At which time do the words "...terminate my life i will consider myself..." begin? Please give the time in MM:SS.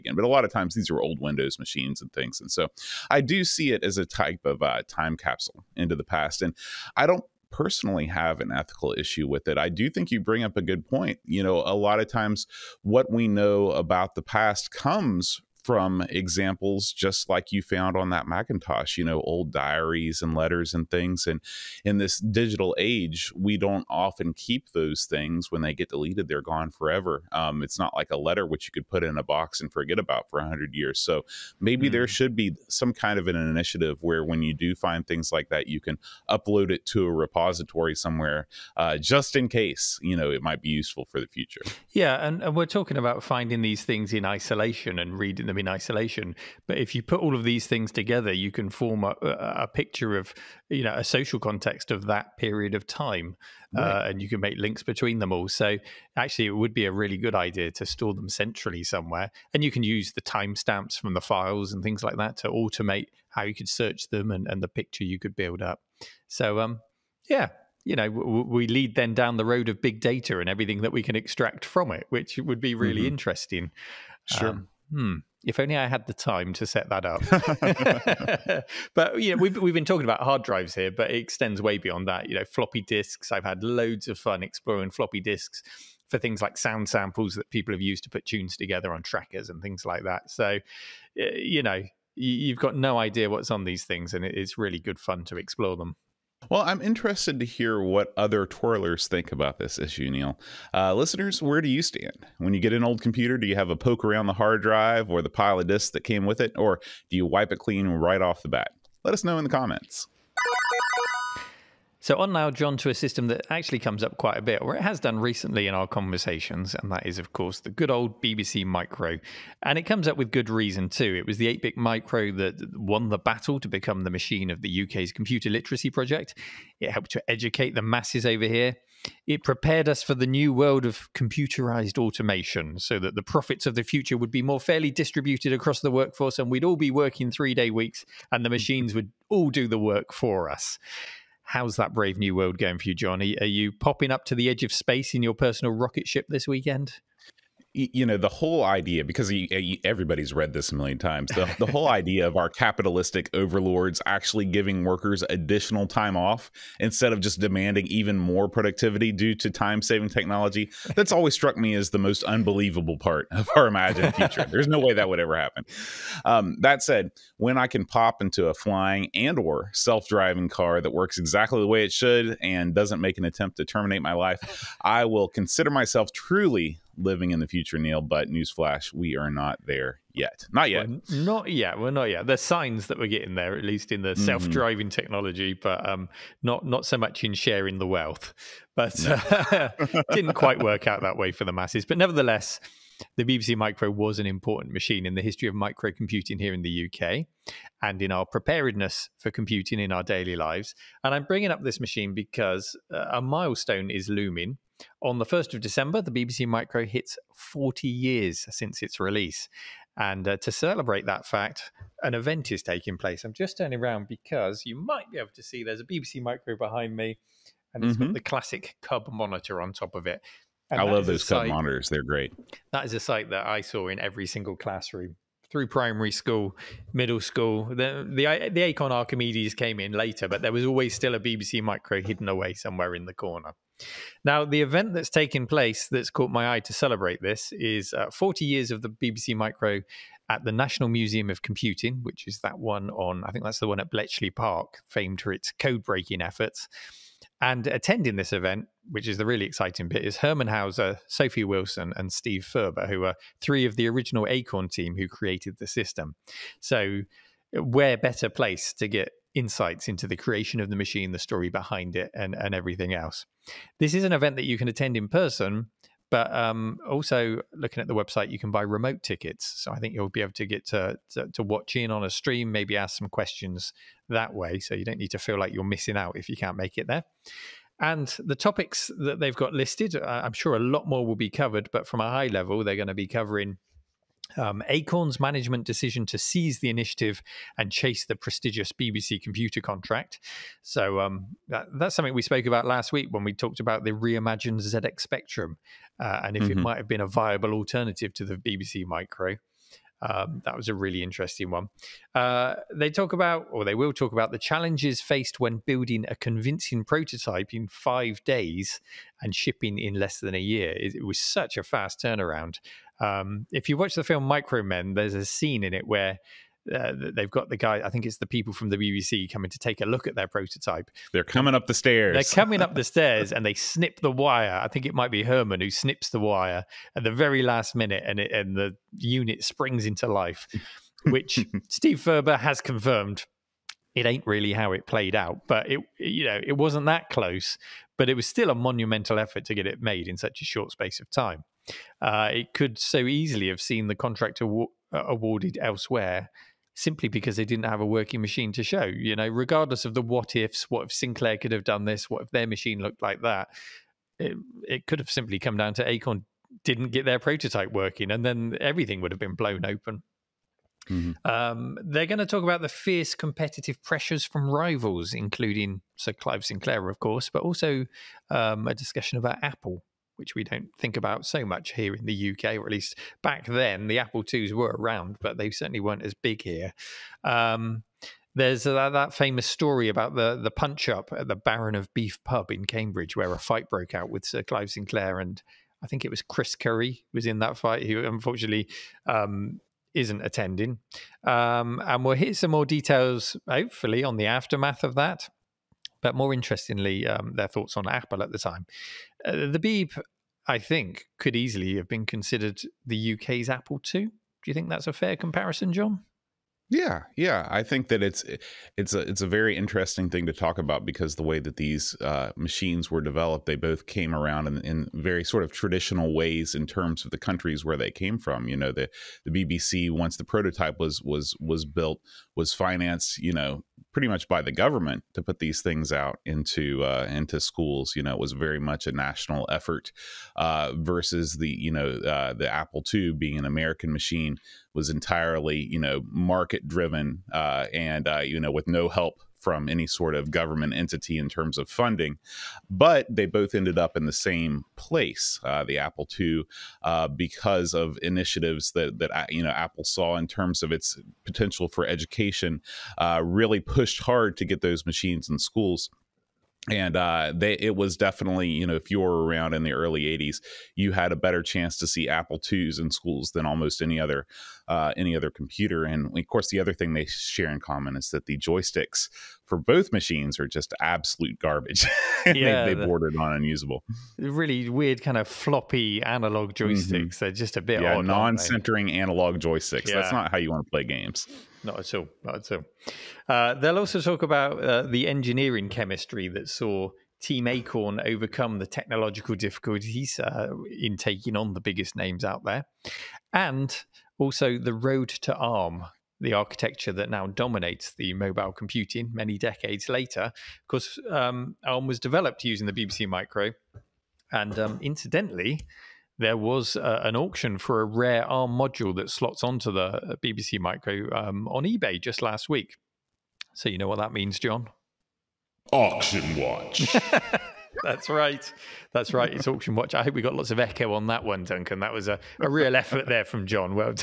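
02:53.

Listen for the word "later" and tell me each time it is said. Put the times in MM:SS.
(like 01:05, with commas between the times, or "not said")
03:49, 08:19.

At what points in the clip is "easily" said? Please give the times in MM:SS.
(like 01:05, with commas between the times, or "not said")
05:42, 06:41.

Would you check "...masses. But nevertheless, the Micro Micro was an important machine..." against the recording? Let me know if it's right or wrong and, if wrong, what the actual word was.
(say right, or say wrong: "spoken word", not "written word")
wrong: "BBC", not "Micro".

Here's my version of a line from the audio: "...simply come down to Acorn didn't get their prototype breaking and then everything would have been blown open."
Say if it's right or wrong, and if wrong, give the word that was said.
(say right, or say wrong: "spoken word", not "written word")
wrong: "working", not "breaking".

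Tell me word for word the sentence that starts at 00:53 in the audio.
uh, and you can make links between them all.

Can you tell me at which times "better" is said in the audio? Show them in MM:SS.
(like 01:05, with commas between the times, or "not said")
04:17, 07:41.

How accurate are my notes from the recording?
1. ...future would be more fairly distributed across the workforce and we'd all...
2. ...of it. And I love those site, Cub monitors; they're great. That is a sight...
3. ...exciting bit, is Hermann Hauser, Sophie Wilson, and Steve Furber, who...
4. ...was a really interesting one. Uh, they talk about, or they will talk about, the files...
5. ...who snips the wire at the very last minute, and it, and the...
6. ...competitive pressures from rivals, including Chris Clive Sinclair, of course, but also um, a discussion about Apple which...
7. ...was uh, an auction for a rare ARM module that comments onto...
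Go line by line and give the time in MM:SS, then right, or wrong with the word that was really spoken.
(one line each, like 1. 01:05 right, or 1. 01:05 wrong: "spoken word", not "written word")
1. 02:13 right
2. 03:39 right
3. 04:09 right
4. 05:00 wrong: "challenges", not "files"
5. 05:25 right
6. 06:03 wrong: "Sir", not "Chris"
7. 08:26 wrong: "slots", not "comments".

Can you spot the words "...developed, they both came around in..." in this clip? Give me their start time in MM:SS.
06:53.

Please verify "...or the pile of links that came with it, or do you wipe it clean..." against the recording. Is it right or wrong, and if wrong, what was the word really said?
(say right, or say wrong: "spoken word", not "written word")
wrong: "disks", not "links".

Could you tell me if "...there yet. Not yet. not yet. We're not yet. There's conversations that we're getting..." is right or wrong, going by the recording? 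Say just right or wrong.
wrong.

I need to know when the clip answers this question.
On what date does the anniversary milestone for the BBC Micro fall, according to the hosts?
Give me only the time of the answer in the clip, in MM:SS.
03:25.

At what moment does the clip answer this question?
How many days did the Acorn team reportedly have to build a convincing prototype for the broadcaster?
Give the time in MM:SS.
05:07.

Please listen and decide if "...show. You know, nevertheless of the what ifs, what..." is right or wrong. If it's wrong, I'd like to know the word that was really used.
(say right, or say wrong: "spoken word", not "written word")
wrong: "regardless", not "nevertheless".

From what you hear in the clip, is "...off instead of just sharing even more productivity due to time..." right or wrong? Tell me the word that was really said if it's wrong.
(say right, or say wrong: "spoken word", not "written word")
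wrong: "demanding", not "sharing".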